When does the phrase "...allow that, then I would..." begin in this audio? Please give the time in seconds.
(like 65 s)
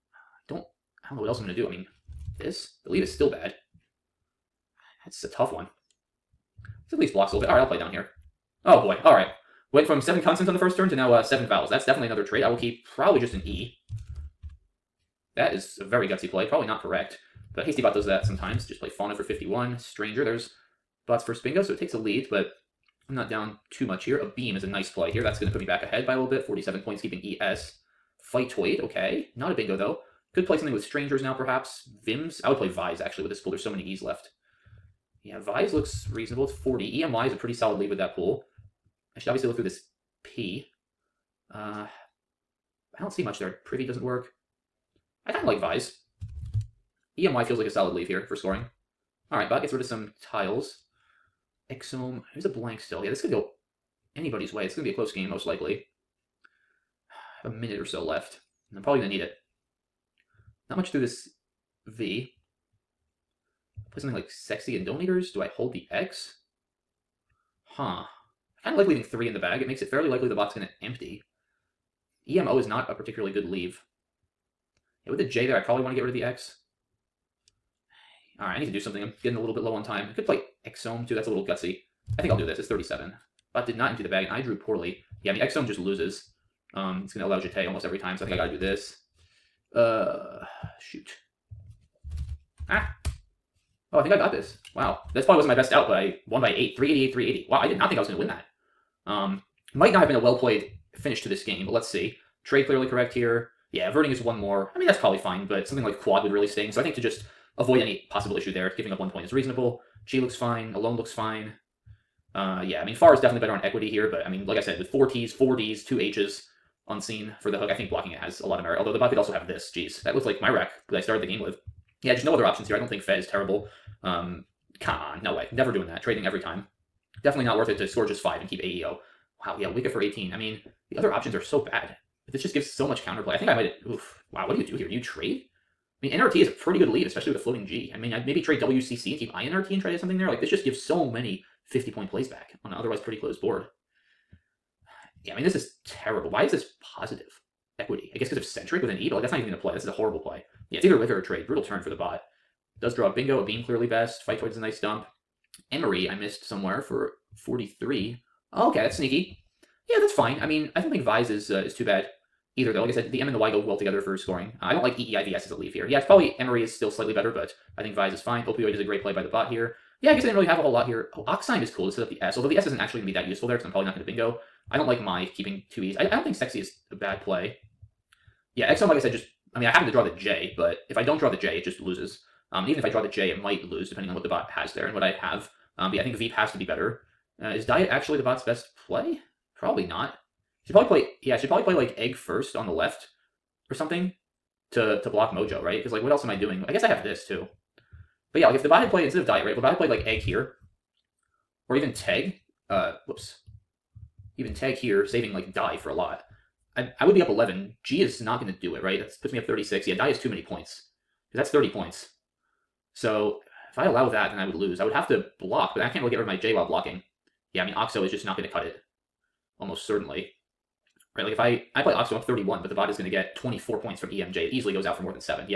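213 s.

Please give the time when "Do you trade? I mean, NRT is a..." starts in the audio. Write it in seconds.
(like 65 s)
134 s.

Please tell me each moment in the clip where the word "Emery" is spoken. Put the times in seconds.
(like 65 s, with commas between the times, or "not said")
155 s, 166 s.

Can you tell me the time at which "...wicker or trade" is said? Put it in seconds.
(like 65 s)
150 s.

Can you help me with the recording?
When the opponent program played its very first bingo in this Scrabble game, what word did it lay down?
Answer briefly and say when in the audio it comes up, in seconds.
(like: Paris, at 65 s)
Stranger, at 19 s.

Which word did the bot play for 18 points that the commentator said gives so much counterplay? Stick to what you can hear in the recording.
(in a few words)
Wicca.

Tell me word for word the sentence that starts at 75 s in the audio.
Yeah, with the J there, I probably want to get rid of the X.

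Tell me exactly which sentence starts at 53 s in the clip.
Yeah, this could go anybody's way.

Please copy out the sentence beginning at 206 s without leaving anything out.
I I would be up eleven.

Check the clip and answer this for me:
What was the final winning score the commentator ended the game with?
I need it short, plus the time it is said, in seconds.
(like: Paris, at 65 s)
388, at 96 s.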